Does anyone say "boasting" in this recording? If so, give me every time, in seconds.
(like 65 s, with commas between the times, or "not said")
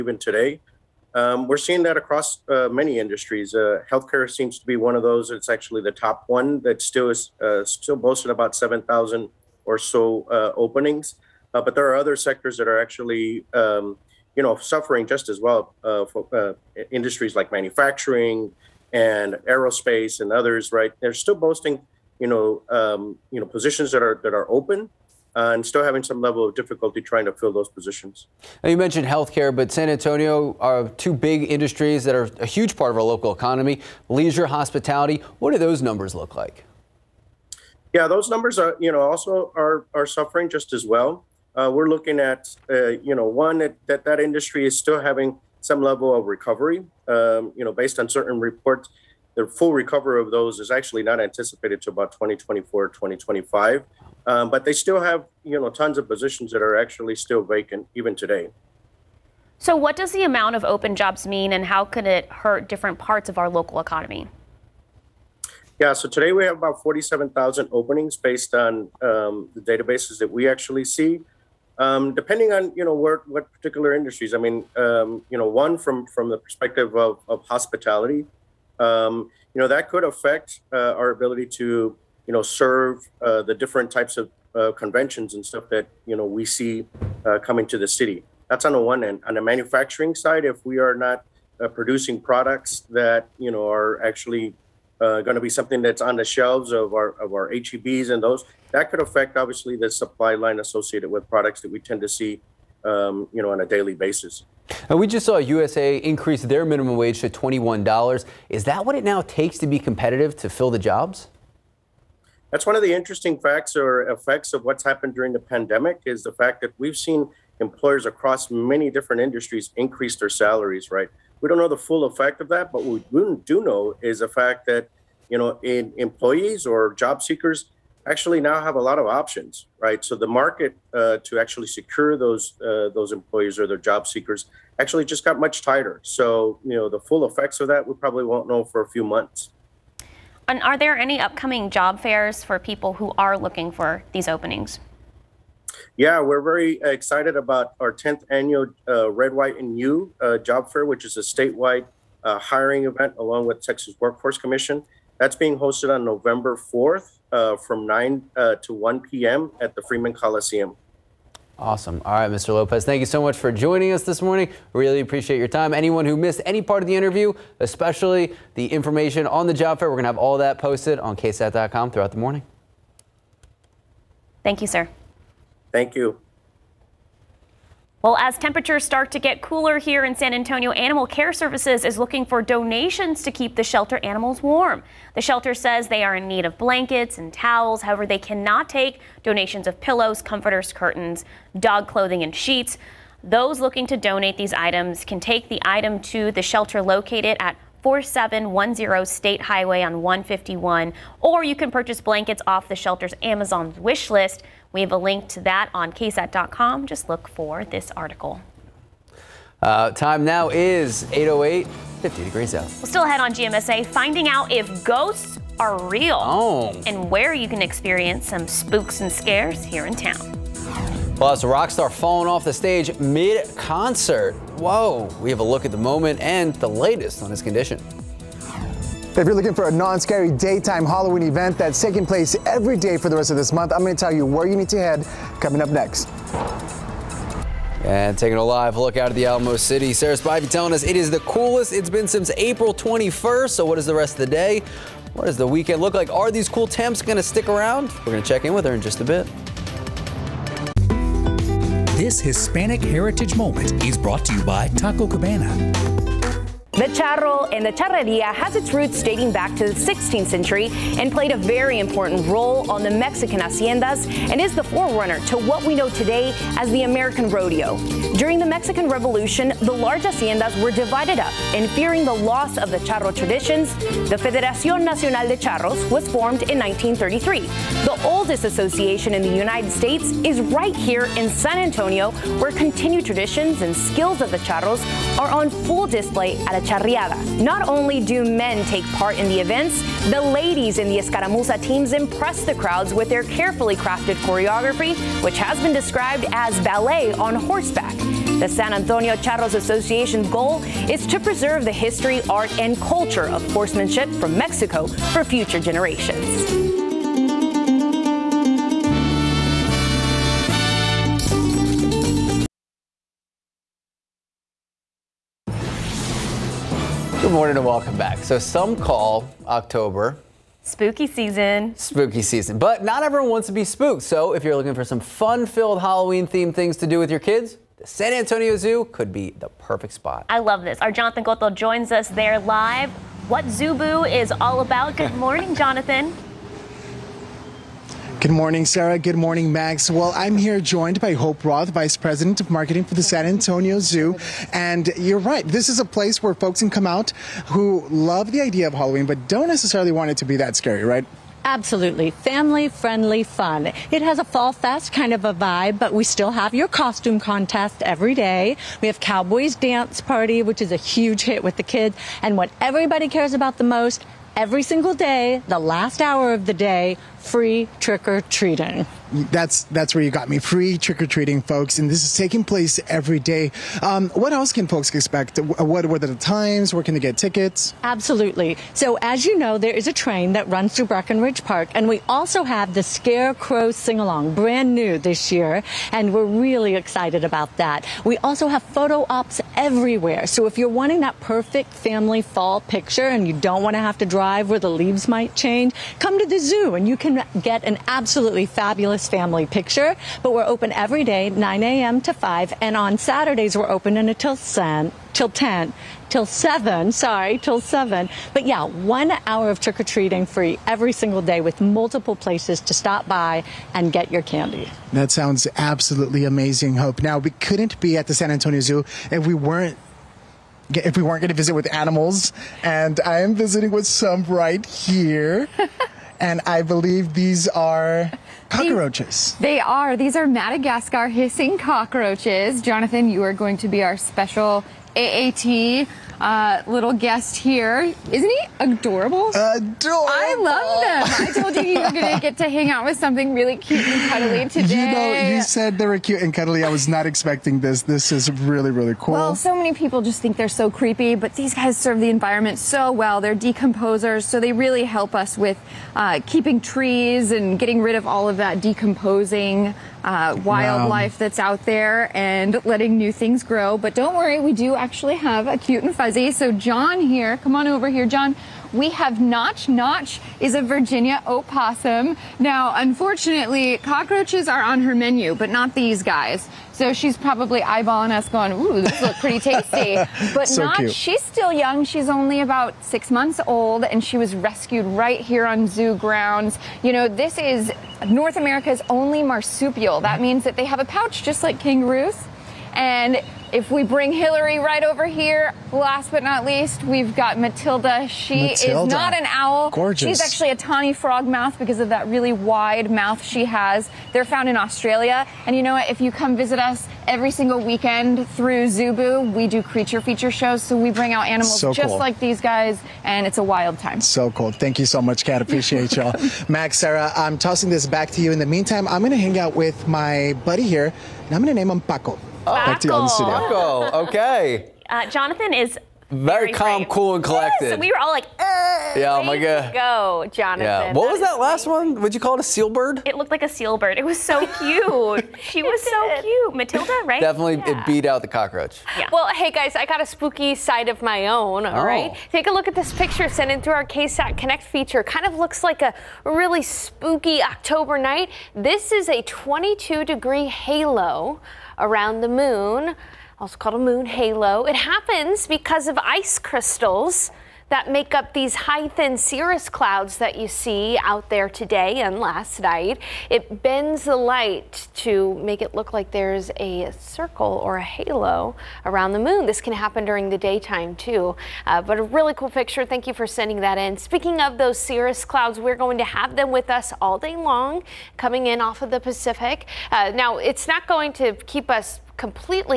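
7 s, 21 s.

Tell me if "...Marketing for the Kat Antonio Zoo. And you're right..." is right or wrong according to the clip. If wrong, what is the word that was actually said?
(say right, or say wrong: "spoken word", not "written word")
wrong: "San", not "Kat".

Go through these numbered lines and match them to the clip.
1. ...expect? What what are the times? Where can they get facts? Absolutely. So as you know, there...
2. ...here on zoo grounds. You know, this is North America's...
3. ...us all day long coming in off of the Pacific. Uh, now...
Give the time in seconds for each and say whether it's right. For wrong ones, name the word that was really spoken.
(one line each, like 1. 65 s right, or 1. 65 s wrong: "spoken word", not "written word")
1. 374 s wrong: "tickets", not "facts"
2. 485 s right
3. 576 s right.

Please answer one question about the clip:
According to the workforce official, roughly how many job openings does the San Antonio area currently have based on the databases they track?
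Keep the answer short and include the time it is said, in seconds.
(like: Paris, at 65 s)
47,000, at 66 s.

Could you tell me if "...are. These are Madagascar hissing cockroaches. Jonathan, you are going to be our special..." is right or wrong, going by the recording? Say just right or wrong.
right.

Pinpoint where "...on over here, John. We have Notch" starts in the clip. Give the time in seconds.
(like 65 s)
467 s.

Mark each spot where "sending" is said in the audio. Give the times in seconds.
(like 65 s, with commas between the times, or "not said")
573 s.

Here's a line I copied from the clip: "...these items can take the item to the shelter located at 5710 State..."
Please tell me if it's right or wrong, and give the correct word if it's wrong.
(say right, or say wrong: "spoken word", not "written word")
wrong: "4710", not "5710".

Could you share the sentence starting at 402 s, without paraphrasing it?
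to 5, and on Saturdays we're open until 10 till 10, till 7, sorry, till 7.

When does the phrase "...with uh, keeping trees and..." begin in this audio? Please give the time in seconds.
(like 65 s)
455 s.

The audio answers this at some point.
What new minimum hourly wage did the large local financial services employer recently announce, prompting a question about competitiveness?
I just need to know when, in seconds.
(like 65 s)
107 s.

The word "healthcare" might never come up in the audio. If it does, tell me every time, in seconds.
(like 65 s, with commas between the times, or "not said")
3 s, 29 s.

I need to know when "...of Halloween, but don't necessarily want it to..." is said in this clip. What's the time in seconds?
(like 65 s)
348 s.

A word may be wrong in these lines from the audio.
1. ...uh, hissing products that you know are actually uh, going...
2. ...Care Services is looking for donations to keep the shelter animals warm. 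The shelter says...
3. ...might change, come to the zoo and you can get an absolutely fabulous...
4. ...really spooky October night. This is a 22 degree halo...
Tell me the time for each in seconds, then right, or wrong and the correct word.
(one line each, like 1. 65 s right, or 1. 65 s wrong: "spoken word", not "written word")
1. 91 s wrong: "producing", not "hissing"
2. 181 s right
3. 395 s right
4. 546 s right.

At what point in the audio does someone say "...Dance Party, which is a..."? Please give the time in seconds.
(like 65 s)
359 s.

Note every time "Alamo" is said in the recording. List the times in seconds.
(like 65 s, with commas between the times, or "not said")
239 s.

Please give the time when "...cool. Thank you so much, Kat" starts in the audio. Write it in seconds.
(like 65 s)
514 s.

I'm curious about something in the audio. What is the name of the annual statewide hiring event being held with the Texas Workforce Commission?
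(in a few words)
Red, White, and You.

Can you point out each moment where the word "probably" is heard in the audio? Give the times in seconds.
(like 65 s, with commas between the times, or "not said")
137 s, 477 s.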